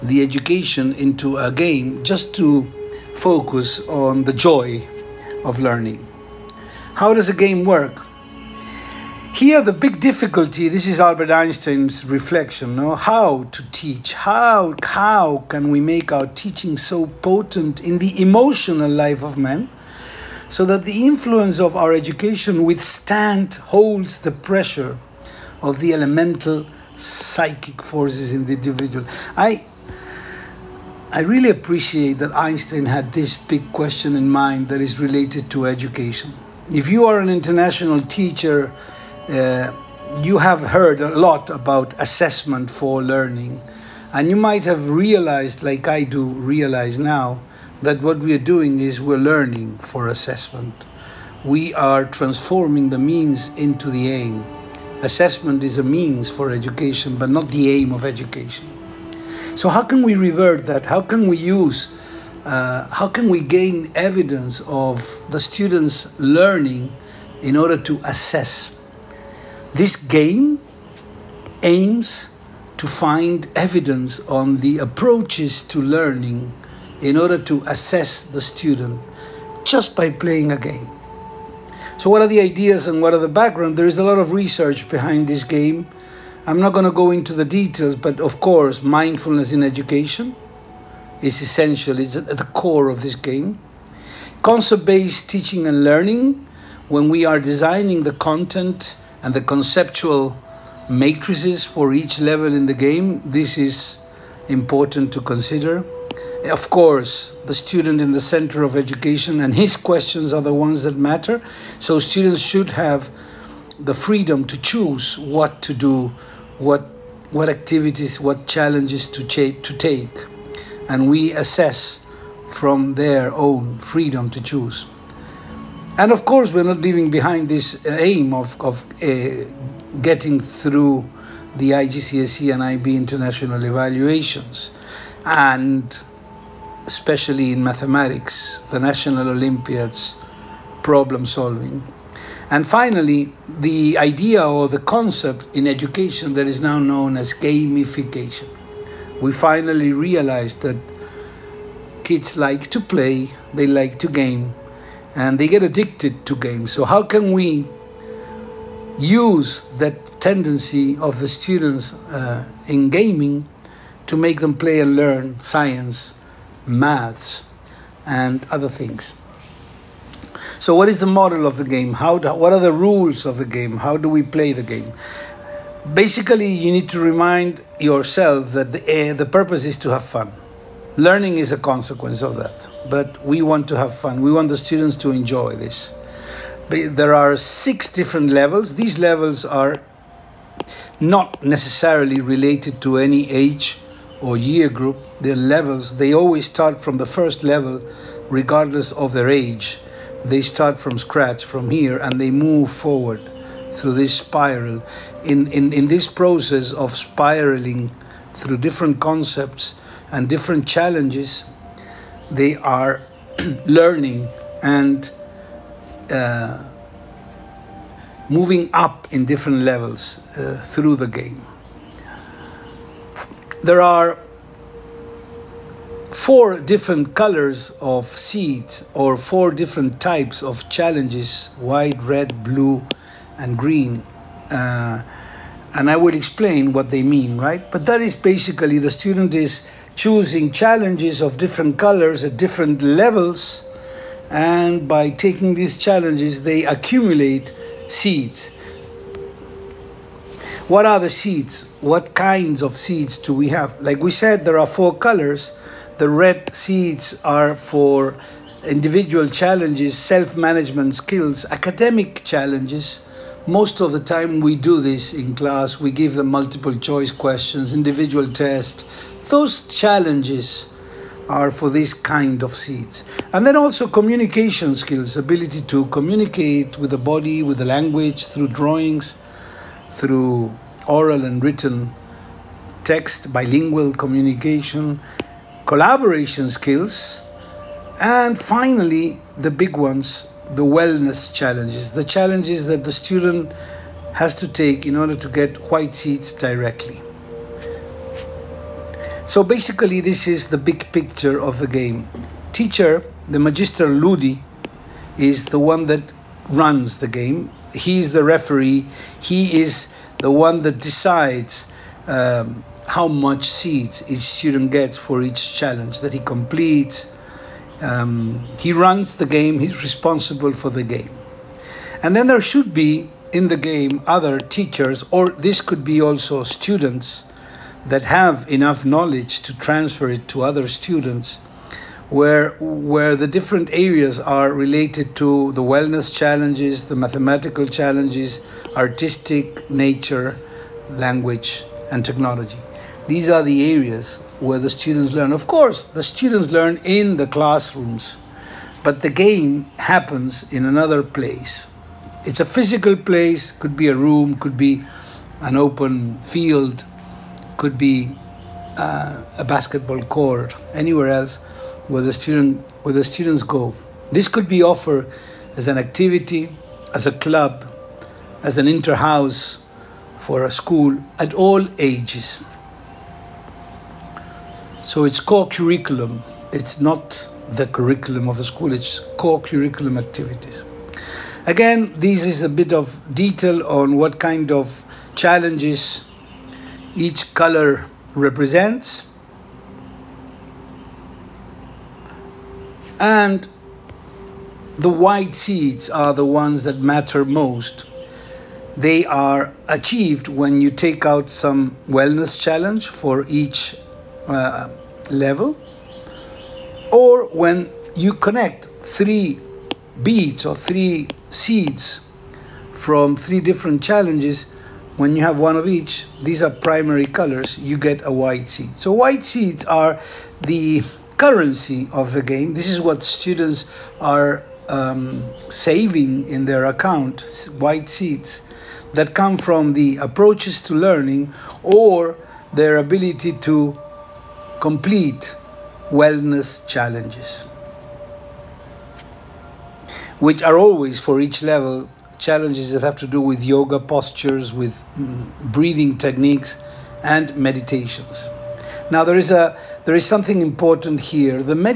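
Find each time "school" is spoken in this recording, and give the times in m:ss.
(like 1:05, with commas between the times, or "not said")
6:10, 6:18.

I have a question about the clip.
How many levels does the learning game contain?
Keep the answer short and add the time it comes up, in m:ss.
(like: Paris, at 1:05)
6, at 3:07.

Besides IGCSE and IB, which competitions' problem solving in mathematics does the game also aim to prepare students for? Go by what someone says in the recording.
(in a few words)
National Olympiads.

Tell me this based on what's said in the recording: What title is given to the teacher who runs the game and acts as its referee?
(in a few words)
Magister Ludi.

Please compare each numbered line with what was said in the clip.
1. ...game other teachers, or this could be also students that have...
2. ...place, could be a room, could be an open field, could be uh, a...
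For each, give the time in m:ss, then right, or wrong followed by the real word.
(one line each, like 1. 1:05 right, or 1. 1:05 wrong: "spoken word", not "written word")
1. 5:23 right
2. 5:52 right.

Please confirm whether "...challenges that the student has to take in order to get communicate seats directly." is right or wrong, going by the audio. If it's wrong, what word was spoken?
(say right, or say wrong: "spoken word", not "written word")
wrong: "white", not "communicate".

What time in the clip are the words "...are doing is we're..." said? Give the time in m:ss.
0:48.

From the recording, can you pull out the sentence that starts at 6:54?
When you have one of each, these are primary colors, you get a white seed.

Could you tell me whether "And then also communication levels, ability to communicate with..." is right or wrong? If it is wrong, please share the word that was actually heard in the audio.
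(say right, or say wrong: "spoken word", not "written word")
wrong: "skills", not "levels".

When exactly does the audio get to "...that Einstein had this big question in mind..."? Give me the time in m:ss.
0:32.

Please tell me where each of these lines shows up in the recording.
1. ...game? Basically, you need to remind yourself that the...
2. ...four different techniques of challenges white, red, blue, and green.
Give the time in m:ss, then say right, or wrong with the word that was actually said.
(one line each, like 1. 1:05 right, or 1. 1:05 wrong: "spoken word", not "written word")
1. 2:54 right
2. 3:49 wrong: "types", not "techniques".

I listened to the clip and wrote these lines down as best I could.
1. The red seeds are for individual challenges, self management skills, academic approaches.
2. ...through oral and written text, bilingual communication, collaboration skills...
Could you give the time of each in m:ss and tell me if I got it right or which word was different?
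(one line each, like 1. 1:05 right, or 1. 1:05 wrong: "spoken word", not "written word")
1. 4:15 wrong: "challenges", not "approaches"
2. 4:39 right.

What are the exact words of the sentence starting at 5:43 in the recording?
These are the areas where the students learn.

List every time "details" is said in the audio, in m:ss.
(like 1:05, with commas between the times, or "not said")
1:27, 6:23.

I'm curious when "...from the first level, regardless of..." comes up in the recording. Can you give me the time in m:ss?
3:16.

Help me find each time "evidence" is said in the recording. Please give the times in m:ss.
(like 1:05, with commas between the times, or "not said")
1:03, 1:13.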